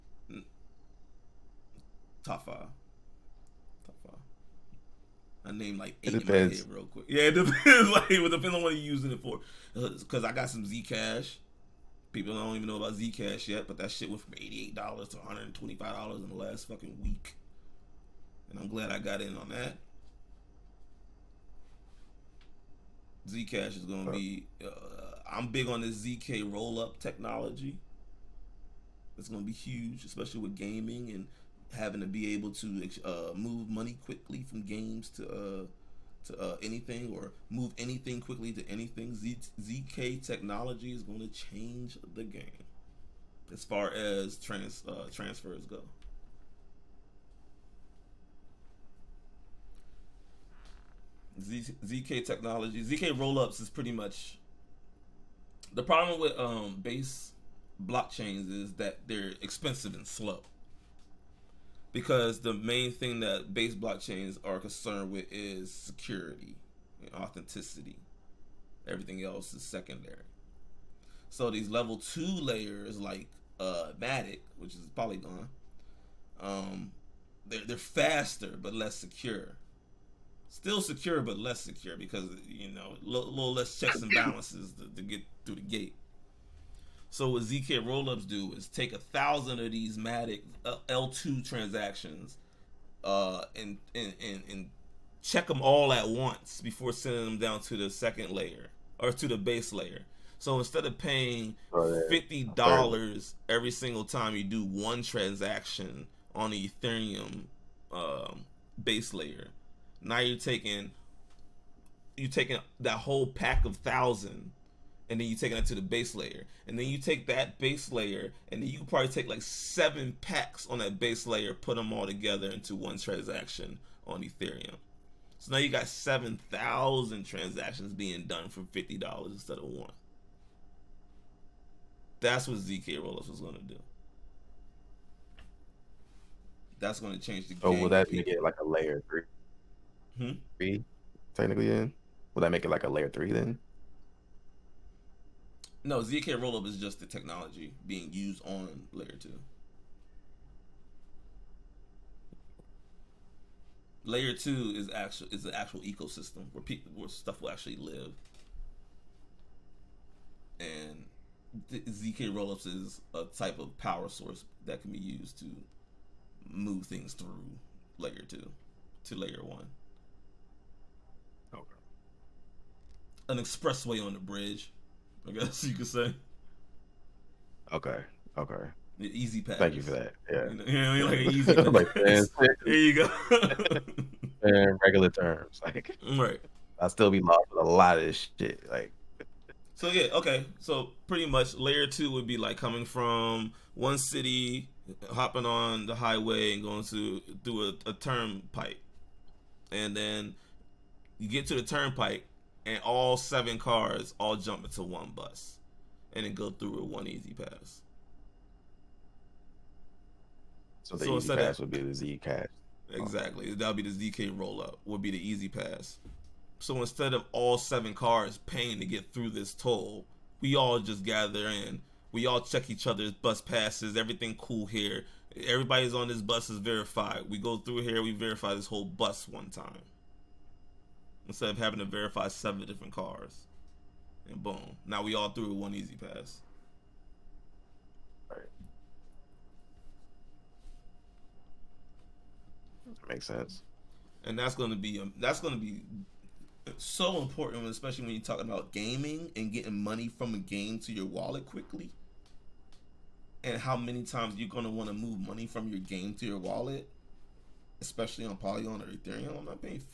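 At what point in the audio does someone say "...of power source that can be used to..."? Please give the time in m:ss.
2:43.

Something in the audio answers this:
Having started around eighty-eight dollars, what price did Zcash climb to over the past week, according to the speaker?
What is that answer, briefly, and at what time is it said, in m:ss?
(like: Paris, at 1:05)
$125, at 0:15.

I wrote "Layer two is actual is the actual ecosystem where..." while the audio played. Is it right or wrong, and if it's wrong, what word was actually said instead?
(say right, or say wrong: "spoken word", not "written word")
right.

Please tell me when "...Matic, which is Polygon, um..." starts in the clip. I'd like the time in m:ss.
1:14.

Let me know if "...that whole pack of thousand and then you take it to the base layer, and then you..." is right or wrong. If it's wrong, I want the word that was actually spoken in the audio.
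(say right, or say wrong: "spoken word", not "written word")
right.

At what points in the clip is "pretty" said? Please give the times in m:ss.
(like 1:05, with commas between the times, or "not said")
0:53, 3:11.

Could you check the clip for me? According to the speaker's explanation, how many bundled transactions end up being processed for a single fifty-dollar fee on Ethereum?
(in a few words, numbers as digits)
7,000.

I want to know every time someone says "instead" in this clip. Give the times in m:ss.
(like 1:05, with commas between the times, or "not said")
1:40, 2:09, 3:36, 3:51.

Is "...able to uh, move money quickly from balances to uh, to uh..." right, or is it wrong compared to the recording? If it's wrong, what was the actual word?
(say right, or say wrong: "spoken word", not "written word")
wrong: "games", not "balances".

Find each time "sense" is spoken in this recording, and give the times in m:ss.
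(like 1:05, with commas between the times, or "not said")
4:03.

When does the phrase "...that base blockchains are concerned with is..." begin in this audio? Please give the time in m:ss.
1:03.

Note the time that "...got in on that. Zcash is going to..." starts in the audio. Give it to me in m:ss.
0:18.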